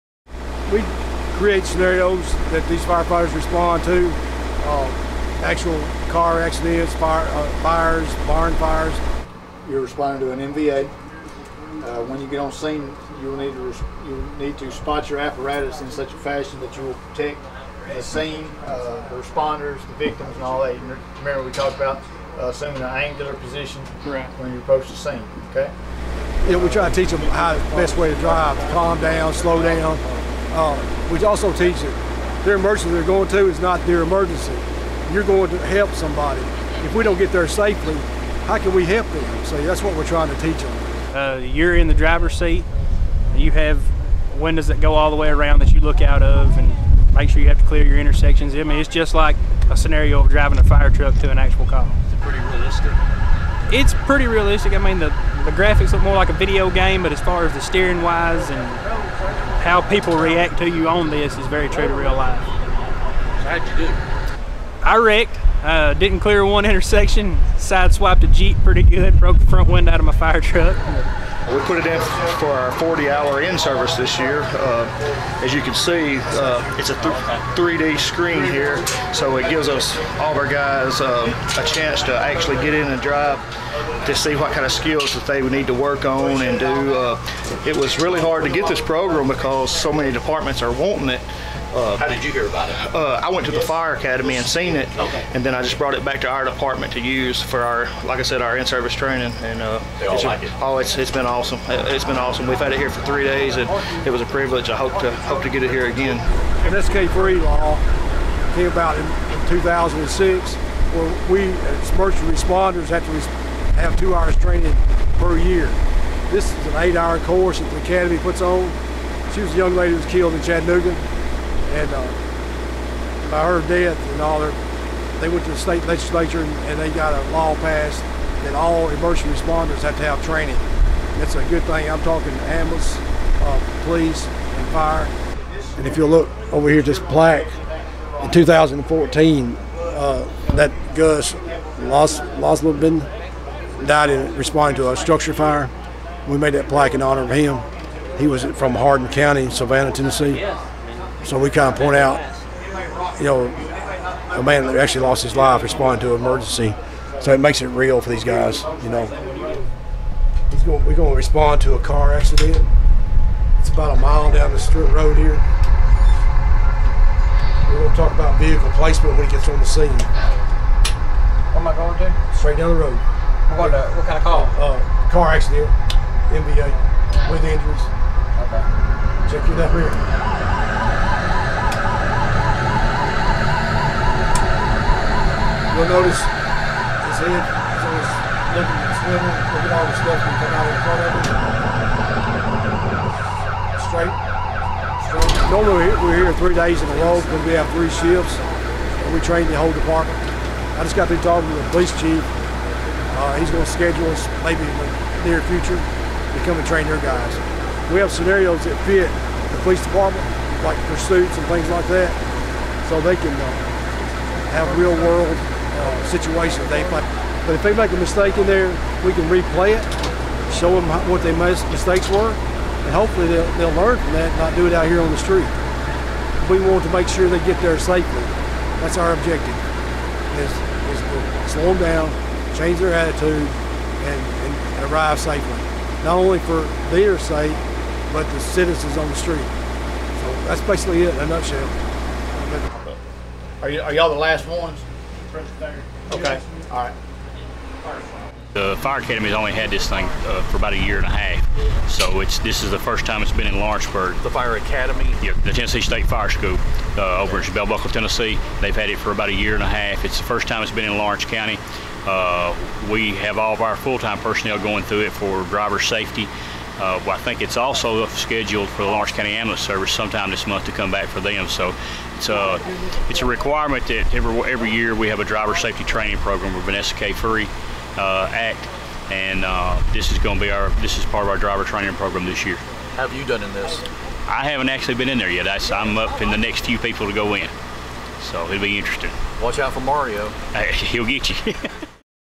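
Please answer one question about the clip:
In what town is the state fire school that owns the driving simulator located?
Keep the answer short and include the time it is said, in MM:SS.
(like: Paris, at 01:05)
Bell Buckle, Tennessee, at 04:17.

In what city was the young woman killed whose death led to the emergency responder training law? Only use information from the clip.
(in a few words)
Chattanooga.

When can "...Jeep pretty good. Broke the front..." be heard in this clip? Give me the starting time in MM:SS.
01:08.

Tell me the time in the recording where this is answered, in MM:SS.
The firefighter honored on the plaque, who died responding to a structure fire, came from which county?
02:28.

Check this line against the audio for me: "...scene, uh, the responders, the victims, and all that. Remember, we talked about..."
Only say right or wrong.
right.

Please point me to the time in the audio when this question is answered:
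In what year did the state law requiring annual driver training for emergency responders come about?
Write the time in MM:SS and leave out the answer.
01:49.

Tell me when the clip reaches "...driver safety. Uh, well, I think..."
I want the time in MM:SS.
04:25.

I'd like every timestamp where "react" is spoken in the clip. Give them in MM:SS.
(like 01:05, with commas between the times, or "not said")
01:00.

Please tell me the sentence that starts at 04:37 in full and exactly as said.
Free uh, Act, and uh, this is going to be our this is part of our driver training program this year.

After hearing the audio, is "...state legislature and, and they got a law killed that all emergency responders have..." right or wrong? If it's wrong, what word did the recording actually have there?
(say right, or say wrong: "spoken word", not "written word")
wrong: "passed", not "killed".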